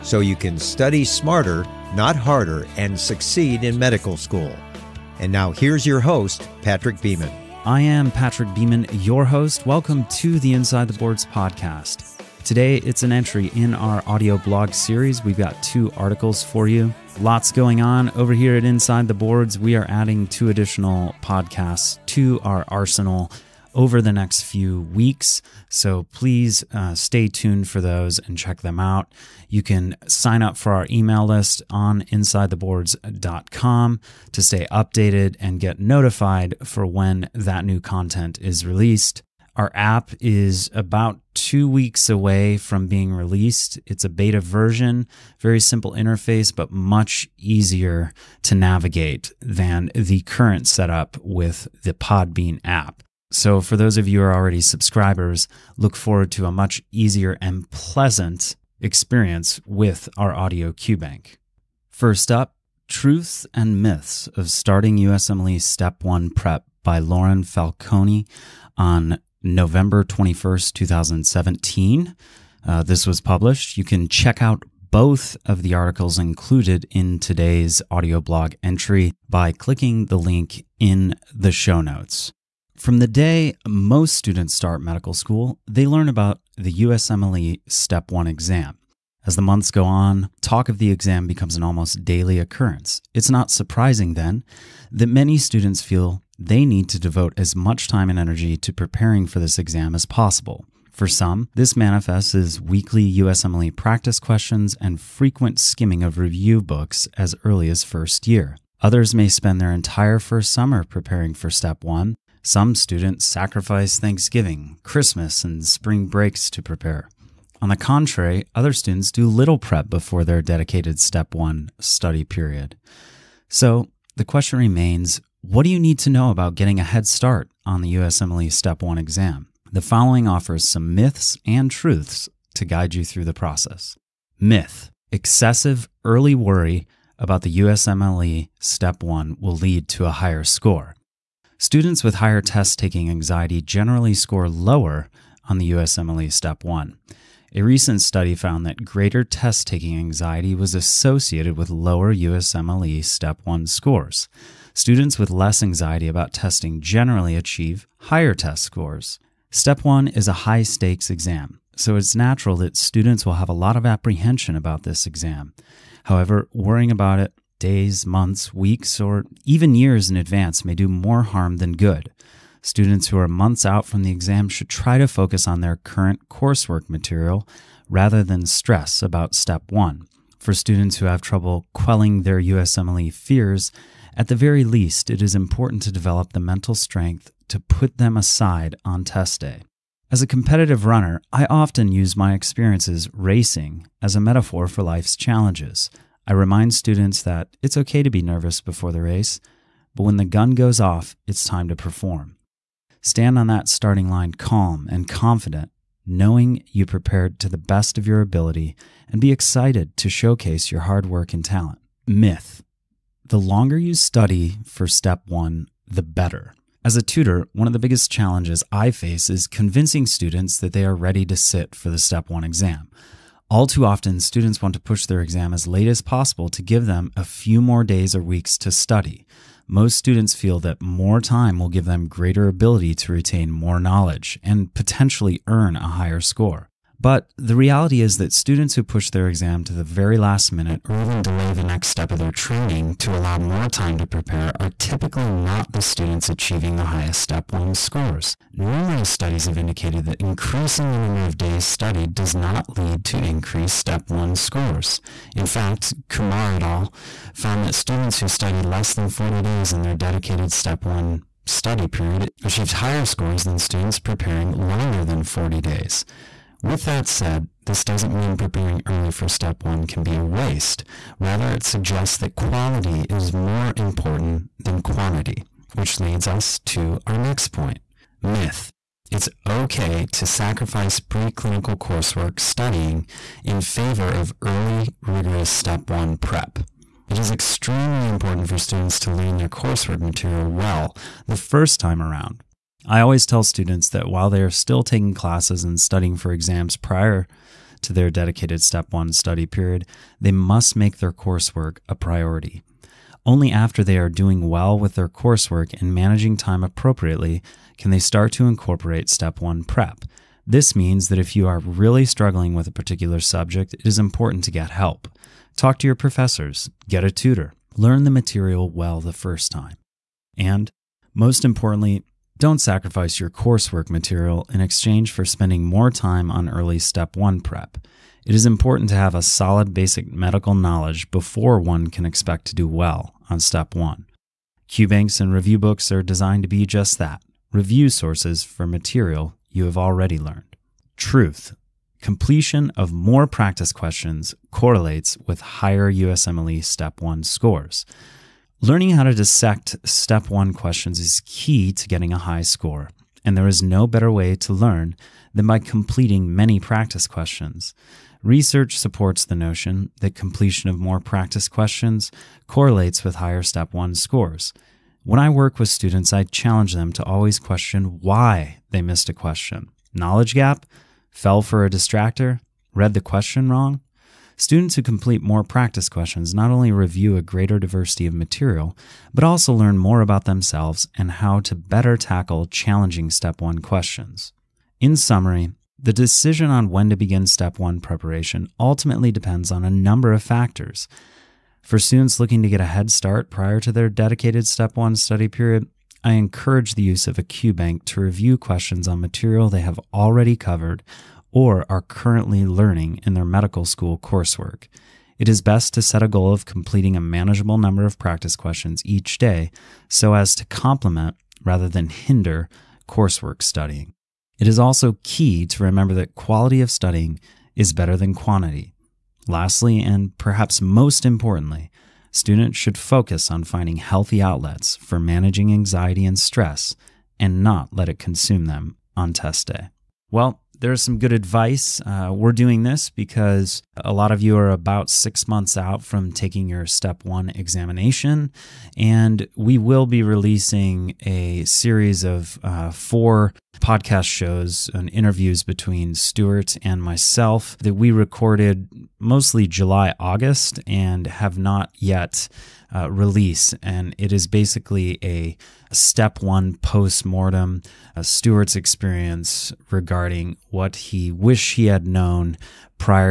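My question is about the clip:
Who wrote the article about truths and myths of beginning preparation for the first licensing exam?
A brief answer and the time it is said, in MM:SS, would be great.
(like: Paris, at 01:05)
Lauren Falcone, at 01:06.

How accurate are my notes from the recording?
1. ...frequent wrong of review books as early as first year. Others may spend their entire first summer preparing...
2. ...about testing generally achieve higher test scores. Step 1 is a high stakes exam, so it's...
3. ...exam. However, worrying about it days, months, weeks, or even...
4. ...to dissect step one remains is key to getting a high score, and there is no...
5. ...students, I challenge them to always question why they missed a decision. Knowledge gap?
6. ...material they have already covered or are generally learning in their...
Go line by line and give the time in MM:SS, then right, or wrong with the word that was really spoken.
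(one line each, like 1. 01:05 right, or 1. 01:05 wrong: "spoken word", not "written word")
1. 01:44 wrong: "skimming", not "wrong"
2. 02:36 right
3. 02:45 right
4. 05:49 wrong: "questions", not "remains"
5. 06:05 wrong: "question", not "decision"
6. 06:38 wrong: "currently", not "generally".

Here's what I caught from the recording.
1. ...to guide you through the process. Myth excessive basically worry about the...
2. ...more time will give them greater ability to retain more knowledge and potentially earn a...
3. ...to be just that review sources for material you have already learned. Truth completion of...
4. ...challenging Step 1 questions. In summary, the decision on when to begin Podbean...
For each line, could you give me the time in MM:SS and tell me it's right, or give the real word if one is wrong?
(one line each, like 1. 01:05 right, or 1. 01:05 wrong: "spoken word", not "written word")
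1. 02:12 wrong: "early", not "basically"
2. 03:50 right
3. 05:36 right
4. 06:22 wrong: "Step", not "Podbean".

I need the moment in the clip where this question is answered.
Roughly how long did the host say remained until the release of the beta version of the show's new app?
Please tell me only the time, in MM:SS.
00:40.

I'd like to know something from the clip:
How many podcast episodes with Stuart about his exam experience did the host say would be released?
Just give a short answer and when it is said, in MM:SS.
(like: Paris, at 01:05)
4, at 07:22.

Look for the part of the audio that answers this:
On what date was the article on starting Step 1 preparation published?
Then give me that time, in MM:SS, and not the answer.
01:09.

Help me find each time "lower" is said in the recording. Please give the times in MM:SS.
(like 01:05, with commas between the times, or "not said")
02:24, 02:31.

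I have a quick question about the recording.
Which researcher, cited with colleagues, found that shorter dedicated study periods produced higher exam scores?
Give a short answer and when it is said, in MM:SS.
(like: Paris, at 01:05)
Kumar, at 04:16.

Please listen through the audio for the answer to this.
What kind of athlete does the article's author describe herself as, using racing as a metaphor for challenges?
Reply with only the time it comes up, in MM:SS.
03:10.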